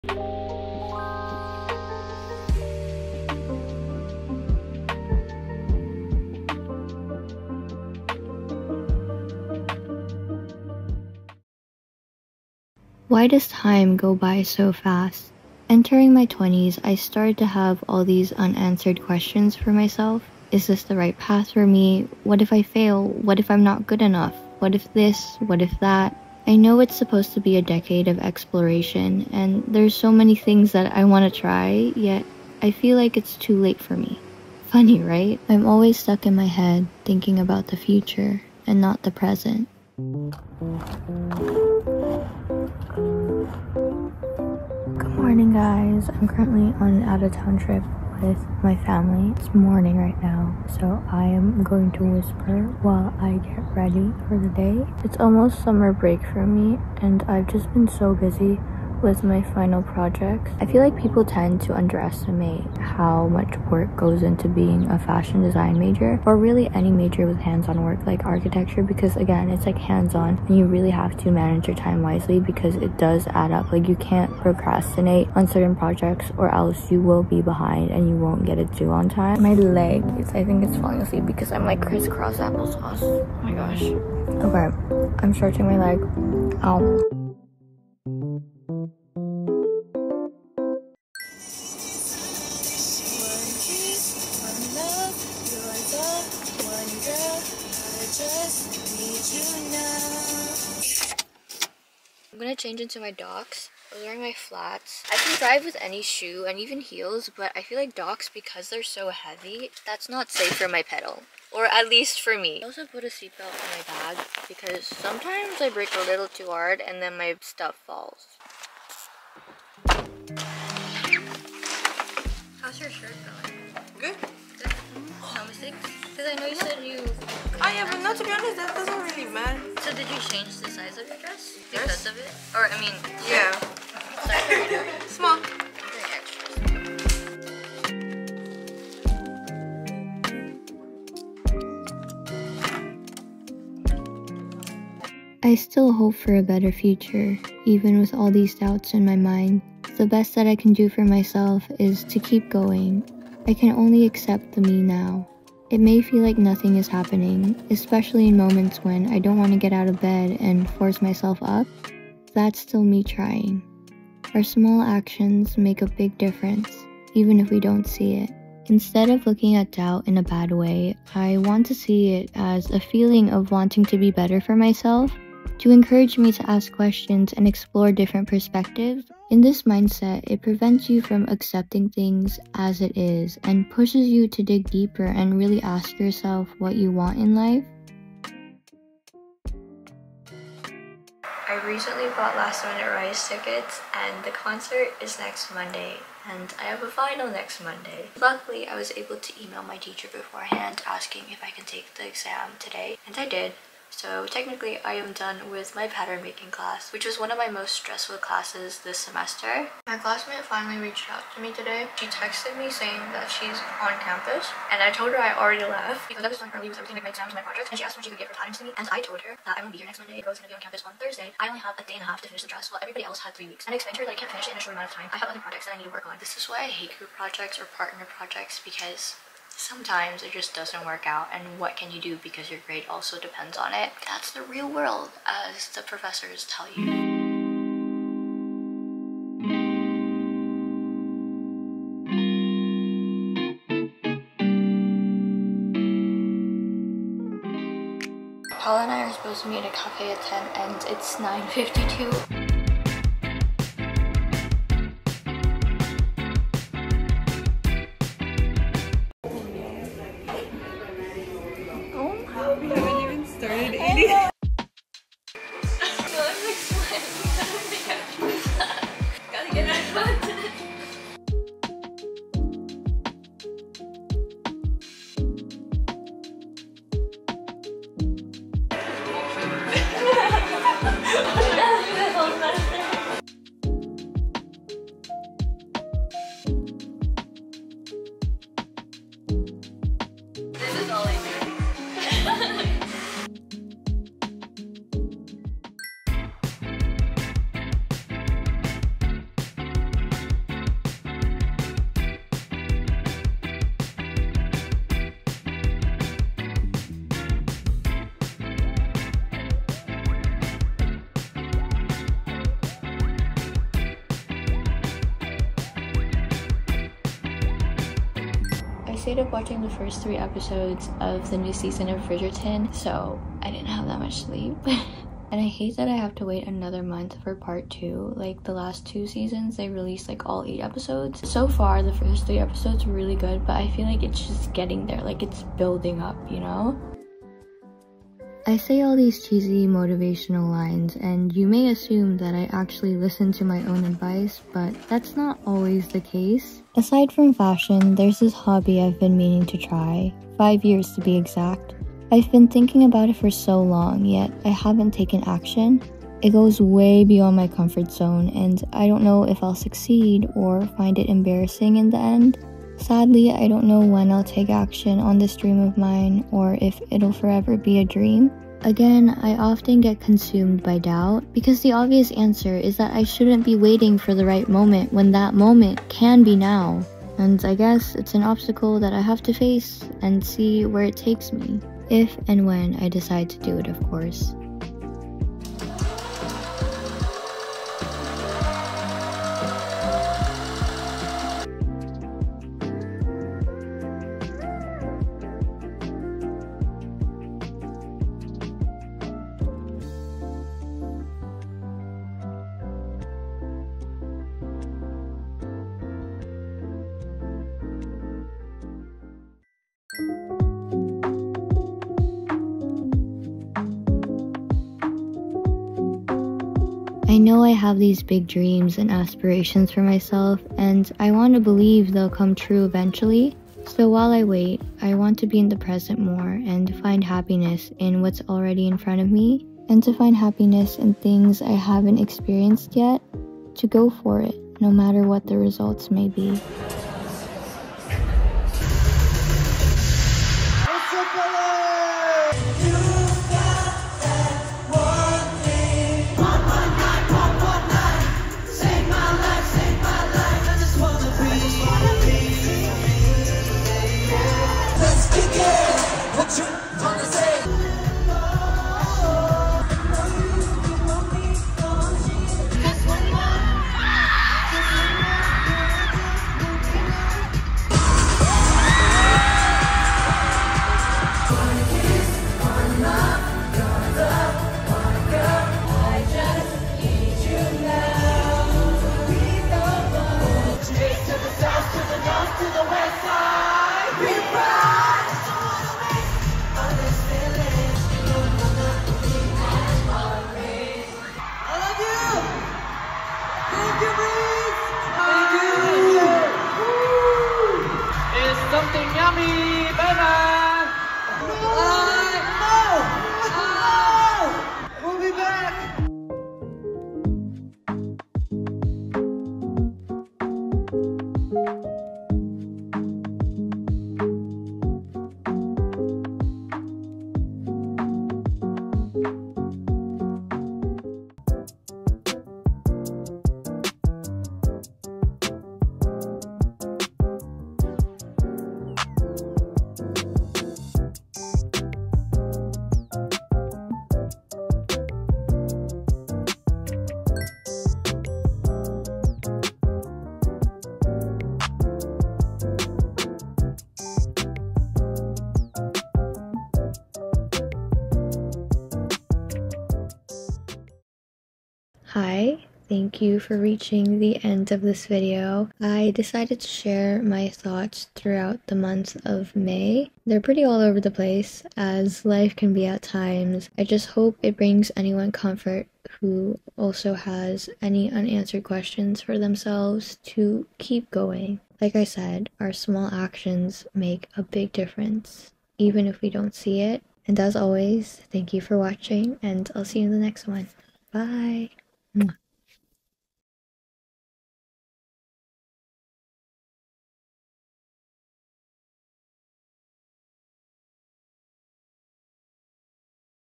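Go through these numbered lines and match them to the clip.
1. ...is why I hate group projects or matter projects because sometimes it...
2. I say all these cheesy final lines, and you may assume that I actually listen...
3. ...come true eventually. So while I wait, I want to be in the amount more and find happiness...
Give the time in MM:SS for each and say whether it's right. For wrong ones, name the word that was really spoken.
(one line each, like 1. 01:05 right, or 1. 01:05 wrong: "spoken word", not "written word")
1. 03:46 wrong: "partner", not "matter"
2. 05:38 wrong: "motivational", not "final"
3. 07:02 wrong: "present", not "amount".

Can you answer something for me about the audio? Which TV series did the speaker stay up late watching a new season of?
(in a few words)
Bridgerton.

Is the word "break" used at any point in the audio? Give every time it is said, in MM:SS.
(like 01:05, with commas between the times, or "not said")
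00:55.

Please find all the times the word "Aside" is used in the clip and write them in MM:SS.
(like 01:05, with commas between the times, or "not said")
05:46.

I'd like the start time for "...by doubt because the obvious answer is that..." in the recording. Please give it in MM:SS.
06:10.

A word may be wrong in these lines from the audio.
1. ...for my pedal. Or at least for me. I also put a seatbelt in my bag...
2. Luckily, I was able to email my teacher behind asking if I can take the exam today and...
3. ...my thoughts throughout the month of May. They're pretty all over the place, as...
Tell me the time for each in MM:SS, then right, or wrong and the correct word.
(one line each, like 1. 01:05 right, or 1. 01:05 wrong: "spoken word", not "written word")
1. 01:50 right
2. 03:18 wrong: "beforehand", not "behind"
3. 09:17 right.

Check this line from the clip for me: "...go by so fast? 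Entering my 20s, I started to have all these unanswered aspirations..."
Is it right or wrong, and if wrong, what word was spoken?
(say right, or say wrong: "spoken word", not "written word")
wrong: "questions", not "aspirations".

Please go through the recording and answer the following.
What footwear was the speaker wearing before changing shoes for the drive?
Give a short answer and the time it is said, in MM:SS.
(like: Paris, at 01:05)
Flats, at 01:44.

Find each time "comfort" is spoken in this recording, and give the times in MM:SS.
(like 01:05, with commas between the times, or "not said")
05:57, 09:25.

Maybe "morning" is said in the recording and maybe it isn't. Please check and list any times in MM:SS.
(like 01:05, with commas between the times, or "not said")
00:45, 00:49.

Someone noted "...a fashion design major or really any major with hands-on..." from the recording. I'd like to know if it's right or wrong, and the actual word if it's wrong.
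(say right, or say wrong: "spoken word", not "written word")
right.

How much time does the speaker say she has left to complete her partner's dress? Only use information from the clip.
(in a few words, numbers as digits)
A day and a half.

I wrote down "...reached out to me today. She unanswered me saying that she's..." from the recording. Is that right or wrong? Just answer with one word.
wrong.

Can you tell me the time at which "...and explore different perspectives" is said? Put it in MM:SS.
02:57.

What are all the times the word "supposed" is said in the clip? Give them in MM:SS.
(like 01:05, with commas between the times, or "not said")
00:26, 04:09.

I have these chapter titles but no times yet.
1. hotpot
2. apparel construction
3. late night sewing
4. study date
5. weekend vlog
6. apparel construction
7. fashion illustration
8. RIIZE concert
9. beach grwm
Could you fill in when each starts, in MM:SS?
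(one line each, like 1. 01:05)
1. 08:58
2. 05:20
3. 06:20
4. 04:10
5. 04:56
6. 01:32
7. 08:43
8. 06:55
9. 00:41.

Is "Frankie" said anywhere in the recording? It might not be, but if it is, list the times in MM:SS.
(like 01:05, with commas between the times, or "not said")
not said.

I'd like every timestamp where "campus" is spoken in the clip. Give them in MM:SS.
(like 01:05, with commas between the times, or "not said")
03:33, 03:40.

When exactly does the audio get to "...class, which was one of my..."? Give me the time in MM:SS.
03:26.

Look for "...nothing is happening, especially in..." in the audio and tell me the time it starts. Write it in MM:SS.
02:36.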